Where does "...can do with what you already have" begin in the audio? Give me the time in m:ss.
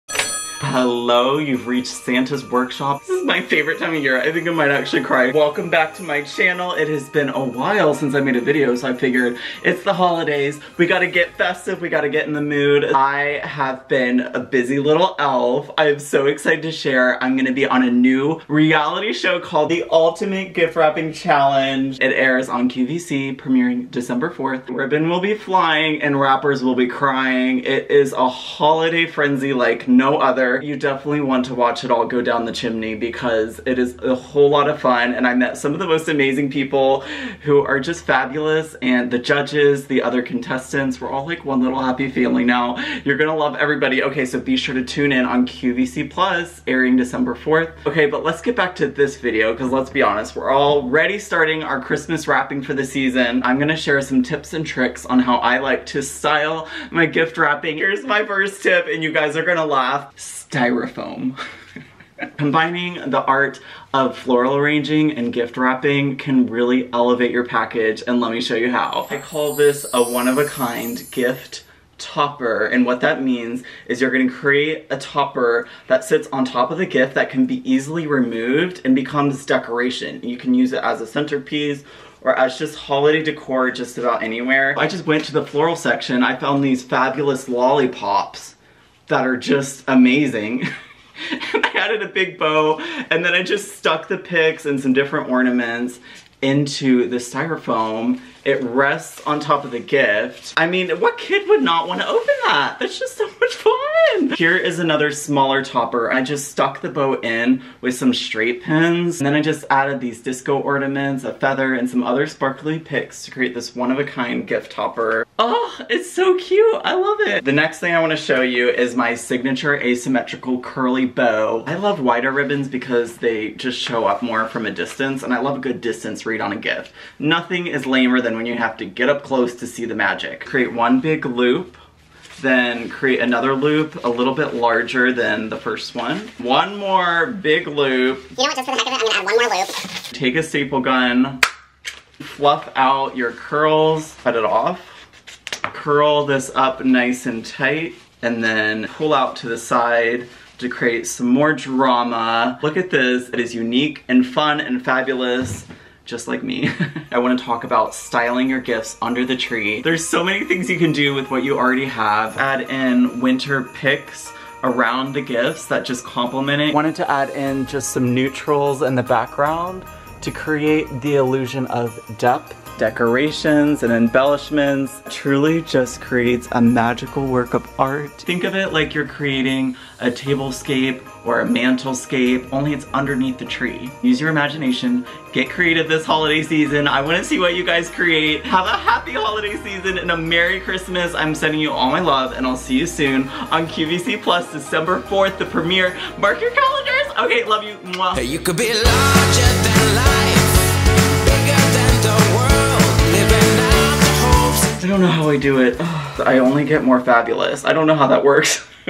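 2:40.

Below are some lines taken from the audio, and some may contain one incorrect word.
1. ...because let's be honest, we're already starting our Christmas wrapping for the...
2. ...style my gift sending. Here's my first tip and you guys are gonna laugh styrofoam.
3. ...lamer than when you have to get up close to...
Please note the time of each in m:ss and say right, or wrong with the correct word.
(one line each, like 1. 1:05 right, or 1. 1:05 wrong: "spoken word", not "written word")
1. 0:49 right
2. 0:56 wrong: "wrapping", not "sending"
3. 2:07 right.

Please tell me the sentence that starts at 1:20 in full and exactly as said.
You can use it as a centerpiece or as just holiday decor just about anywhere.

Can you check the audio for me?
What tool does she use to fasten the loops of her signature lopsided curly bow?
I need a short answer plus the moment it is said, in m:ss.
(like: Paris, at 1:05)
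Staple gun, at 2:20.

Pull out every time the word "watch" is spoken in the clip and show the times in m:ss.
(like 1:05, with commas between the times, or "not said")
0:31.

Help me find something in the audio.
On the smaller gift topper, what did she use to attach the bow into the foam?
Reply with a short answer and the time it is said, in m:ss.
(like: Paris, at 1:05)
Straight pins, at 1:48.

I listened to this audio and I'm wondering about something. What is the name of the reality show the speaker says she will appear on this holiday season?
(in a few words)
The Ultimate Gift Wrapping Challenge.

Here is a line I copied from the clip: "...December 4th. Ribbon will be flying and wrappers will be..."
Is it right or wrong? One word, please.
right.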